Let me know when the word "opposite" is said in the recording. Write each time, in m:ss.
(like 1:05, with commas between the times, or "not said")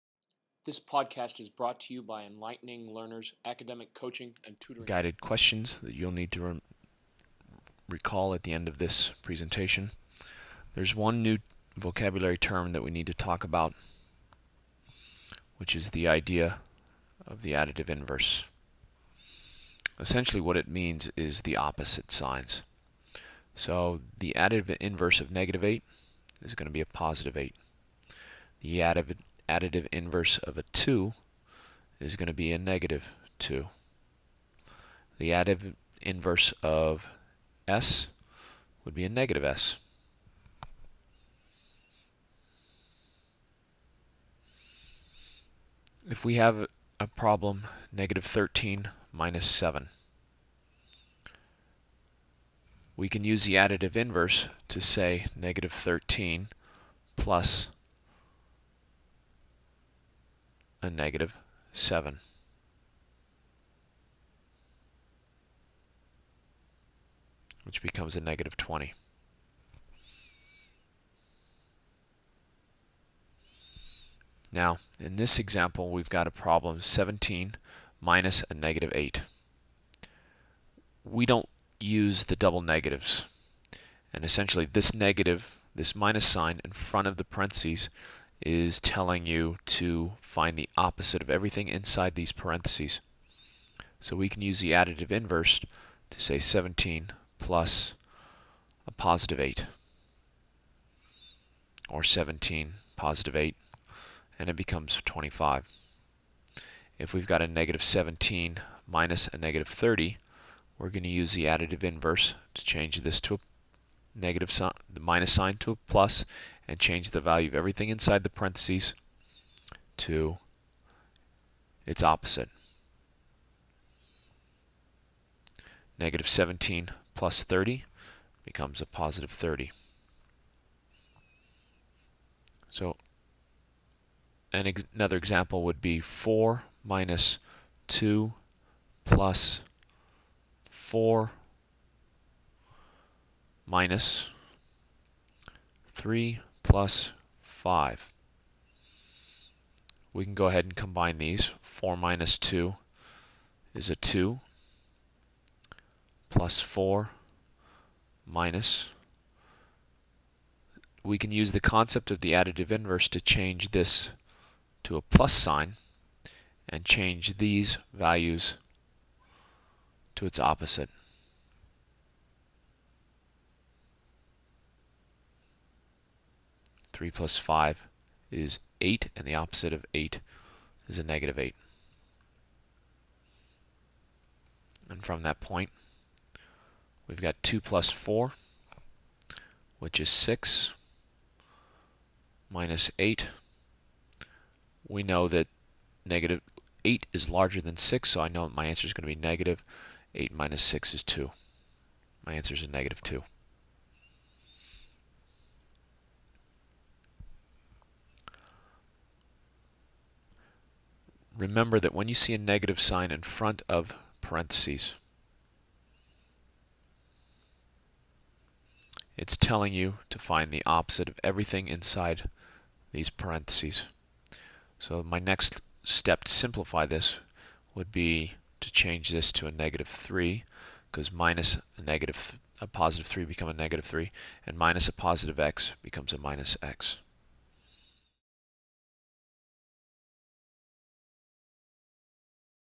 0:21, 1:30, 2:02, 2:50, 2:59, 3:40.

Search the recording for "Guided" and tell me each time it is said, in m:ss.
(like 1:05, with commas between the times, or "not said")
0:04.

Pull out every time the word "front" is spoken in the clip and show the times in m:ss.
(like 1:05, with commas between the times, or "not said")
1:26, 3:33.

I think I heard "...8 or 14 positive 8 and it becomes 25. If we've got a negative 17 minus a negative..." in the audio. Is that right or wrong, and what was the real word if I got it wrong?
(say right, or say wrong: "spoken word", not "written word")
wrong: "17", not "14".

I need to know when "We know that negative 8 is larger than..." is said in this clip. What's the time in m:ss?
3:14.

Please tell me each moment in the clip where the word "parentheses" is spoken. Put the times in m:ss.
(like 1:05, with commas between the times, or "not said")
1:27, 1:32, 1:58, 3:34, 3:43.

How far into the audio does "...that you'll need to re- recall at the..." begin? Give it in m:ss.
0:05.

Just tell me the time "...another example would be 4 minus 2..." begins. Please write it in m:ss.
2:14.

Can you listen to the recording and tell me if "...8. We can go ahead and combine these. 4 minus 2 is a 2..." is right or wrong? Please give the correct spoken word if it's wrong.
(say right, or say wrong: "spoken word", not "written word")
wrong: "5", not "8".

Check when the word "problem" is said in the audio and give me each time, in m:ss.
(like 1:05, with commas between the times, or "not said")
0:47, 1:16.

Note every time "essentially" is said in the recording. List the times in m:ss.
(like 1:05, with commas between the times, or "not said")
0:19, 1:24.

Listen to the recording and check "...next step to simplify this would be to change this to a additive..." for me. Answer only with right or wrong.
wrong.